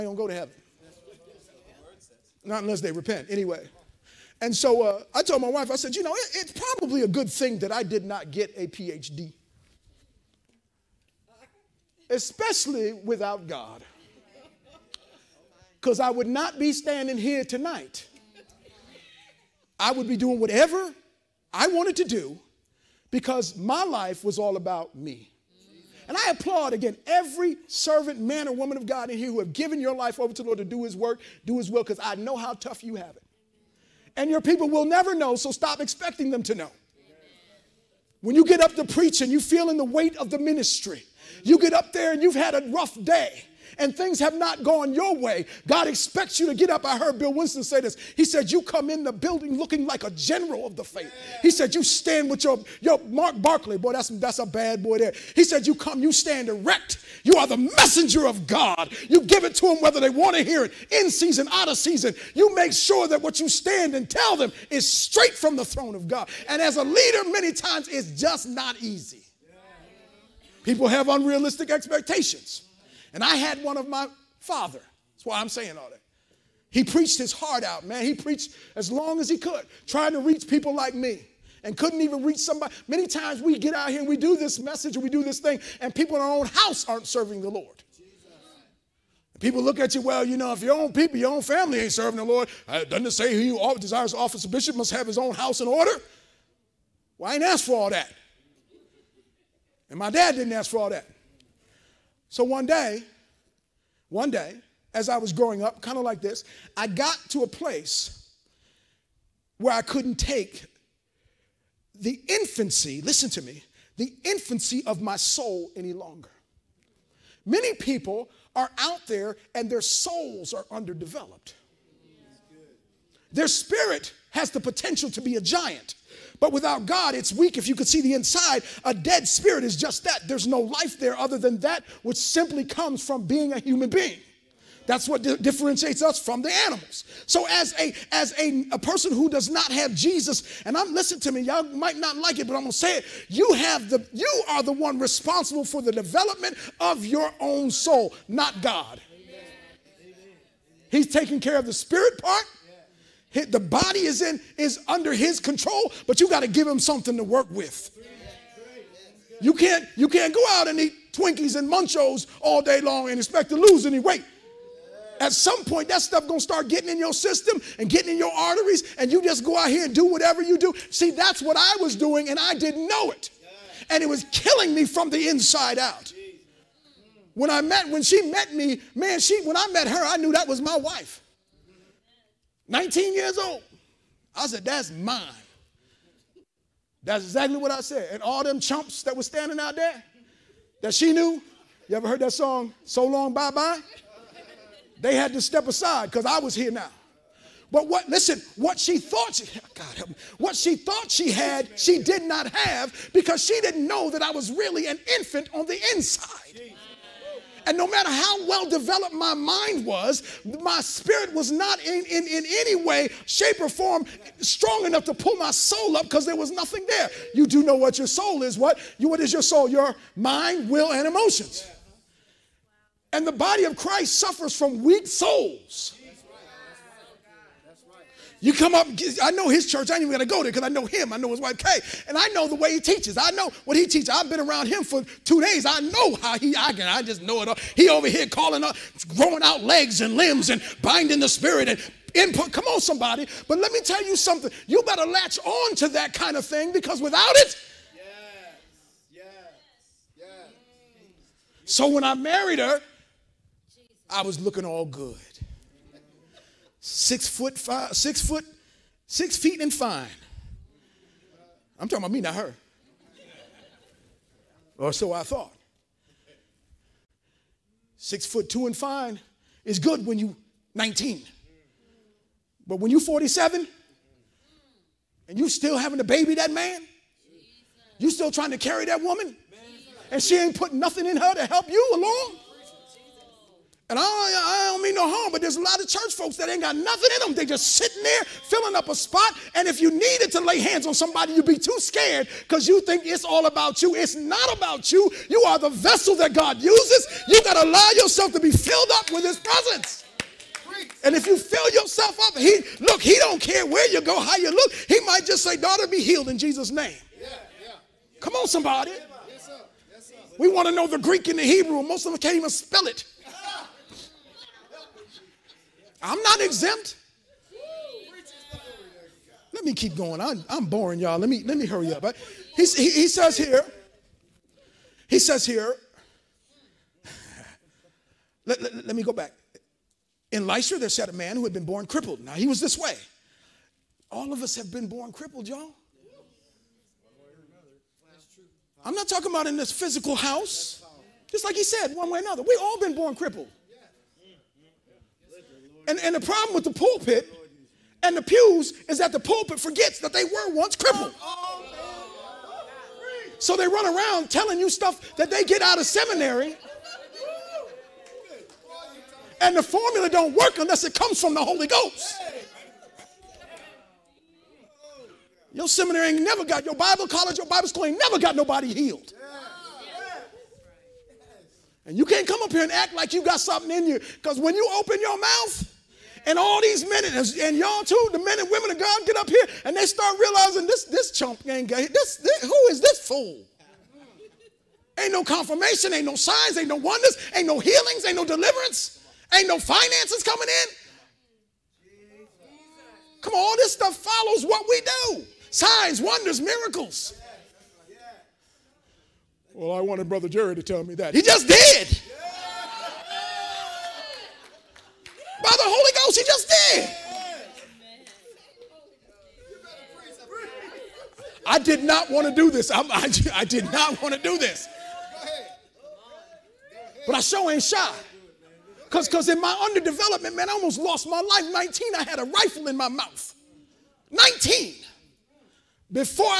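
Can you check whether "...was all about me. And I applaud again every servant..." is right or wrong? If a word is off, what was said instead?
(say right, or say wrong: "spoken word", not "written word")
right.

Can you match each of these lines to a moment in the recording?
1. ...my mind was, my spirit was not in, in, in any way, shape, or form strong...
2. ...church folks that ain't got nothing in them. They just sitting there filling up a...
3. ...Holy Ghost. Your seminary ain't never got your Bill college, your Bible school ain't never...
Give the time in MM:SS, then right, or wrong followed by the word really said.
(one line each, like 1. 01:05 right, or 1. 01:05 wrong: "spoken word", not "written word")
1. 03:29 right
2. 04:45 right
3. 06:01 wrong: "Bible", not "Bill".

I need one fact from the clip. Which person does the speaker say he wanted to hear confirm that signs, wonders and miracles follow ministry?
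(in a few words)
Brother Jerry.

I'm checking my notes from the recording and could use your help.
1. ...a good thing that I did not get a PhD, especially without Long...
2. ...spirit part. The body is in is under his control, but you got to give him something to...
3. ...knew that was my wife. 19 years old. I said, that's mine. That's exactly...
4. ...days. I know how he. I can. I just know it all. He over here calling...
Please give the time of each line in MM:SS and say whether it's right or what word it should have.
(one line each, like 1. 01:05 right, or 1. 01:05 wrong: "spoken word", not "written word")
1. 00:07 wrong: "God", not "Long"
2. 02:31 right
3. 03:00 right
4. 03:55 right.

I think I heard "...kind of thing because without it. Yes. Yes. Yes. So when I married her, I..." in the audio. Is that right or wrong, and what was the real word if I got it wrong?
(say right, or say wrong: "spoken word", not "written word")
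right.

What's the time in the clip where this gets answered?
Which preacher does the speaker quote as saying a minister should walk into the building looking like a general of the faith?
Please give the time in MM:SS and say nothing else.
00:47.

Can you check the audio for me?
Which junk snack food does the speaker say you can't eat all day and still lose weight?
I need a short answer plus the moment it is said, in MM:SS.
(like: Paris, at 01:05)
Twinkies, at 02:41.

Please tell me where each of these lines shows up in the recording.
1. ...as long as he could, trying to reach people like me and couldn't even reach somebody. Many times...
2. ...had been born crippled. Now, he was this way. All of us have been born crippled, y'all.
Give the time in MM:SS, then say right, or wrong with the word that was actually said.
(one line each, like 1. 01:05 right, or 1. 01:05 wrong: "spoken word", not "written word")
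1. 01:18 right
2. 05:31 right.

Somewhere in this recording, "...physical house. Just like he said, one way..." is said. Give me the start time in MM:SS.
05:39.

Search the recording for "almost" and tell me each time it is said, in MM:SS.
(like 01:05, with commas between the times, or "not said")
07:00.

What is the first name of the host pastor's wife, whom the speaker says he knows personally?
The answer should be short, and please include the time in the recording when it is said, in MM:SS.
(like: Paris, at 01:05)
Kay, at 03:51.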